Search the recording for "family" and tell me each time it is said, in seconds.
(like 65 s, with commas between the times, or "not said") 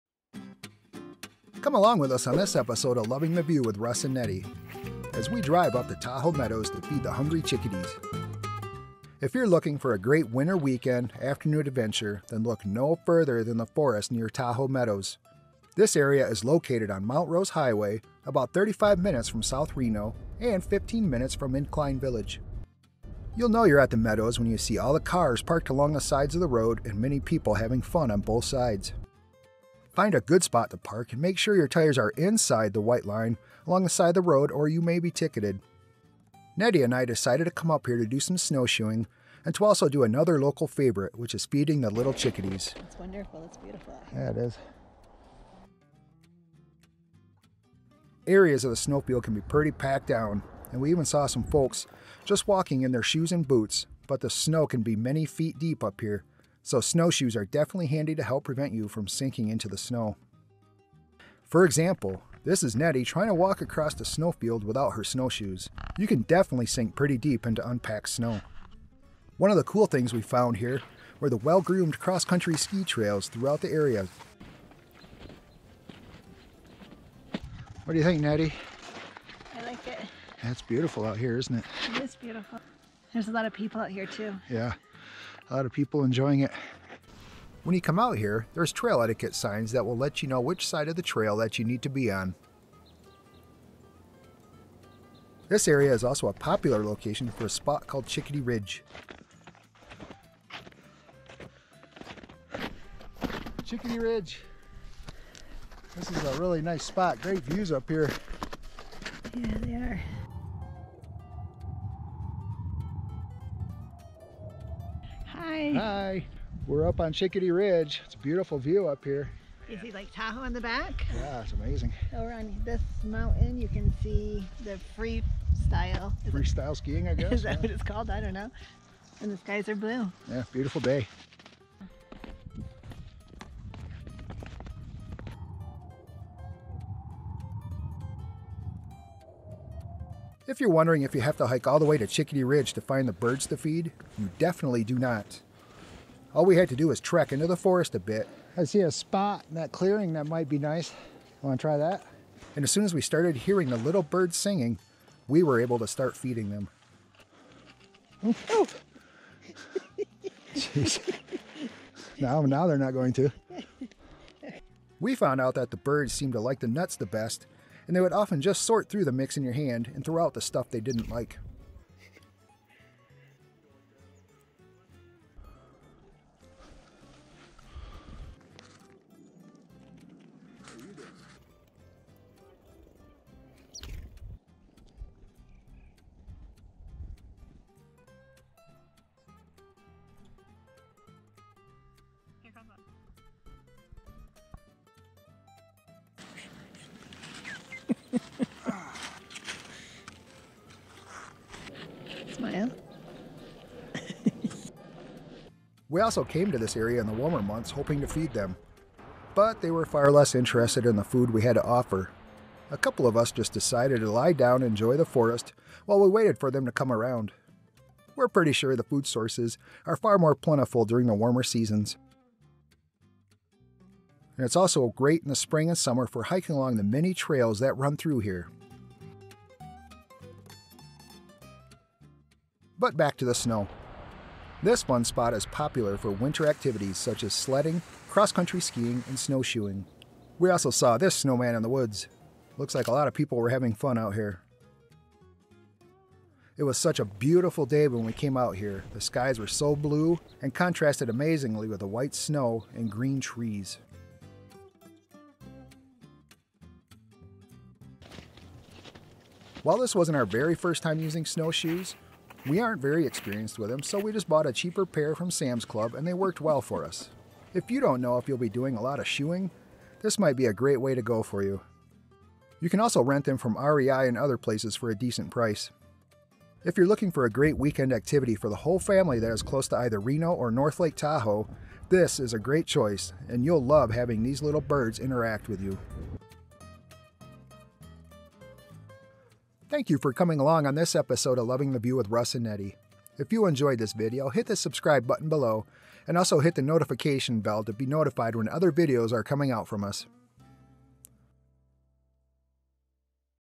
278 s.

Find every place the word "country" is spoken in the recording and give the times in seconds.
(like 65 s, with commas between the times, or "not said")
71 s, 238 s.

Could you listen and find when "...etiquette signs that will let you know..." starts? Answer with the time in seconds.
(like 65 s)
89 s.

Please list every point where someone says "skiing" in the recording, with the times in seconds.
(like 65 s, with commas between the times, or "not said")
126 s, 238 s.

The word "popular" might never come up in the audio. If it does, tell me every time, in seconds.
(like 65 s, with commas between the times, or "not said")
96 s, 235 s.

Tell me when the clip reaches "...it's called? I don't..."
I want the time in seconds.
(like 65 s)
127 s.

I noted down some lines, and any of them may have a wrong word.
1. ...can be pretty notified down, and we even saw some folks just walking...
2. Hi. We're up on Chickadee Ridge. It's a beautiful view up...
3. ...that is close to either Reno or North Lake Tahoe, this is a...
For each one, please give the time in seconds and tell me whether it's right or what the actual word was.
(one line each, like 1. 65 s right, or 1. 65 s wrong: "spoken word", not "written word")
1. 49 s wrong: "packed", not "notified"
2. 115 s right
3. 279 s right.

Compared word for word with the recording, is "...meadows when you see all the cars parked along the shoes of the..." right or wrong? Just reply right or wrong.
wrong.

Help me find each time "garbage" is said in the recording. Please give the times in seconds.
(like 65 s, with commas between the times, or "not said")
not said.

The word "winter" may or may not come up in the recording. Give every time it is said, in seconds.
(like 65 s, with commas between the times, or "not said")
10 s, 236 s.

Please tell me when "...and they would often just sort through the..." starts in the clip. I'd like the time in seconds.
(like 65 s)
167 s.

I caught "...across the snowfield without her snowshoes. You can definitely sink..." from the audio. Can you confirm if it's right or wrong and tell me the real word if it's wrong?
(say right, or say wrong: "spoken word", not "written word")
right.